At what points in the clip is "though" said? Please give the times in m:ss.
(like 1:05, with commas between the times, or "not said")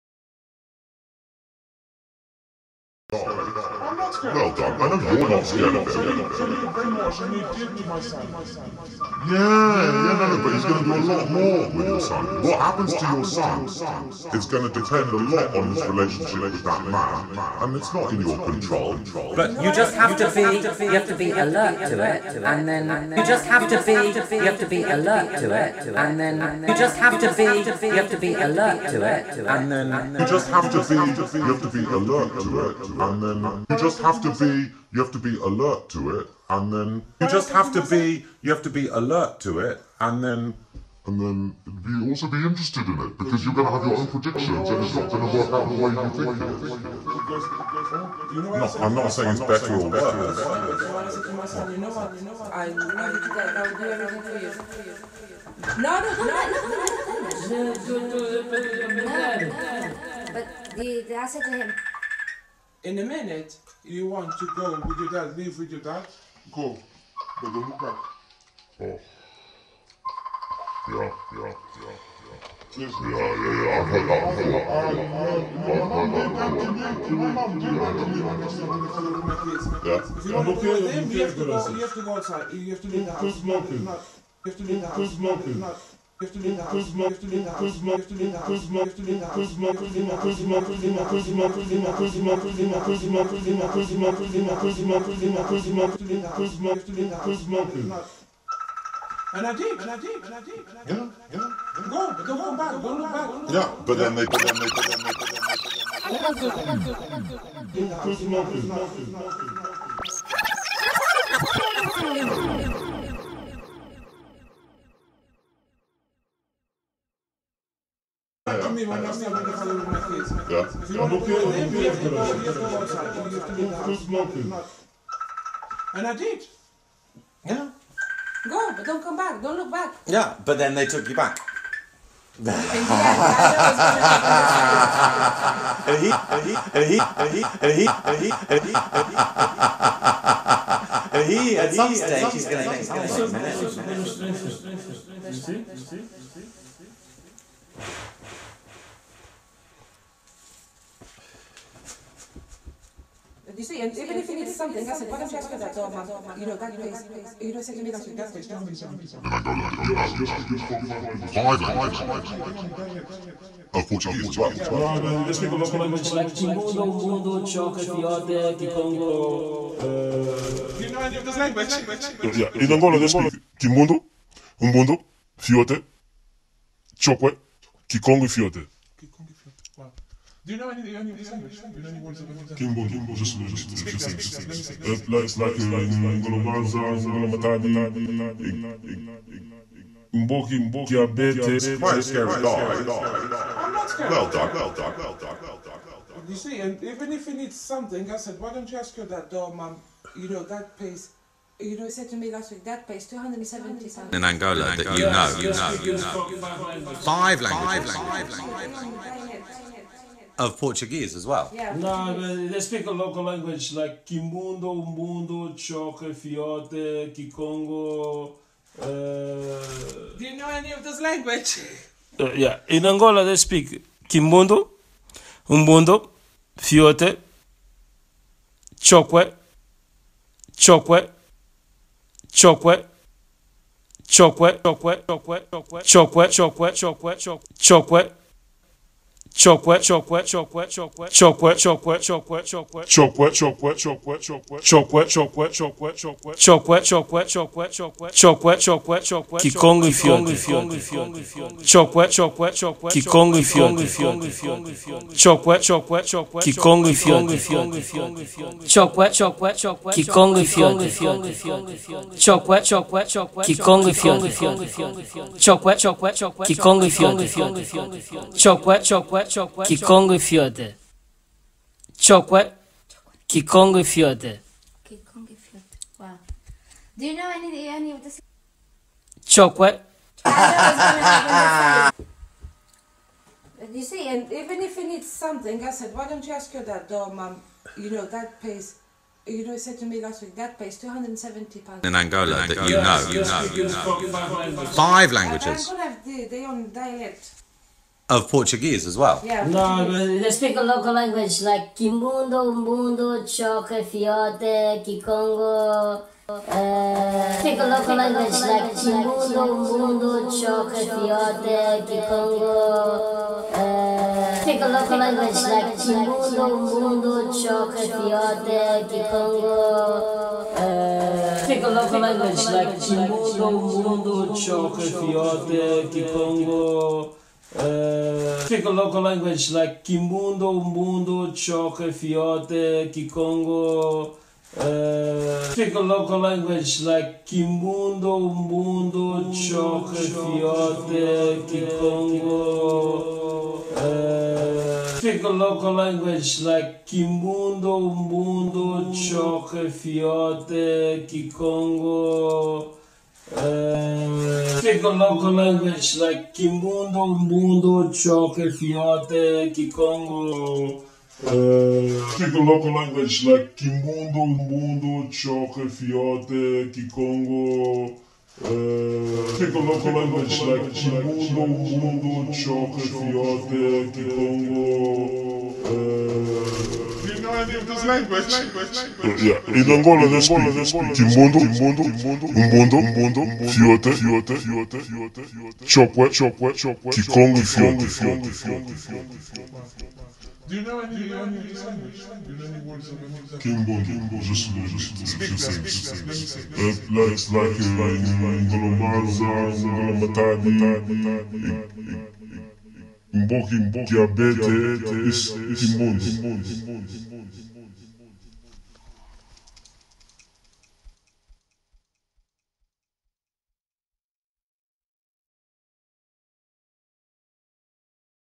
4:46.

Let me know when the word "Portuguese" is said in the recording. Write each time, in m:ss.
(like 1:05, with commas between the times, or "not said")
3:30, 4:58.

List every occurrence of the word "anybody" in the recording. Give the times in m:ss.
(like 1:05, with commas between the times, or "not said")
not said.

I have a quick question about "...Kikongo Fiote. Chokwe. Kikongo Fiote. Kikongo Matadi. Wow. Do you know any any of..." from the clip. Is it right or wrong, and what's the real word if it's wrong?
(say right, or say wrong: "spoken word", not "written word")
wrong: "Fiote", not "Matadi".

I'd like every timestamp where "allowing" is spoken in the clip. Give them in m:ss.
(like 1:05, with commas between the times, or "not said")
not said.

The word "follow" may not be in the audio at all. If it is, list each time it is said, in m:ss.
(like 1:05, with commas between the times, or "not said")
1:59.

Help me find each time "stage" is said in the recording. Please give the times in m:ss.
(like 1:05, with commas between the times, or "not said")
2:21.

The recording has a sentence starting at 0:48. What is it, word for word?
No, I'm not saying it's better or worse.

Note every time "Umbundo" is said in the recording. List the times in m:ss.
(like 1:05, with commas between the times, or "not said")
2:54, 3:45.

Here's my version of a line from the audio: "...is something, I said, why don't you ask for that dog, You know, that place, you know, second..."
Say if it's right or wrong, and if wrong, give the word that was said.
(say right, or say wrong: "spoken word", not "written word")
right.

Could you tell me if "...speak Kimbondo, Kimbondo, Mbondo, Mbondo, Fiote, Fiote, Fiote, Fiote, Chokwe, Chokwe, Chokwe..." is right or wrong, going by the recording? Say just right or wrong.
right.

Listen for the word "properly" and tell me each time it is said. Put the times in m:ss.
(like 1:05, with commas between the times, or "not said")
not said.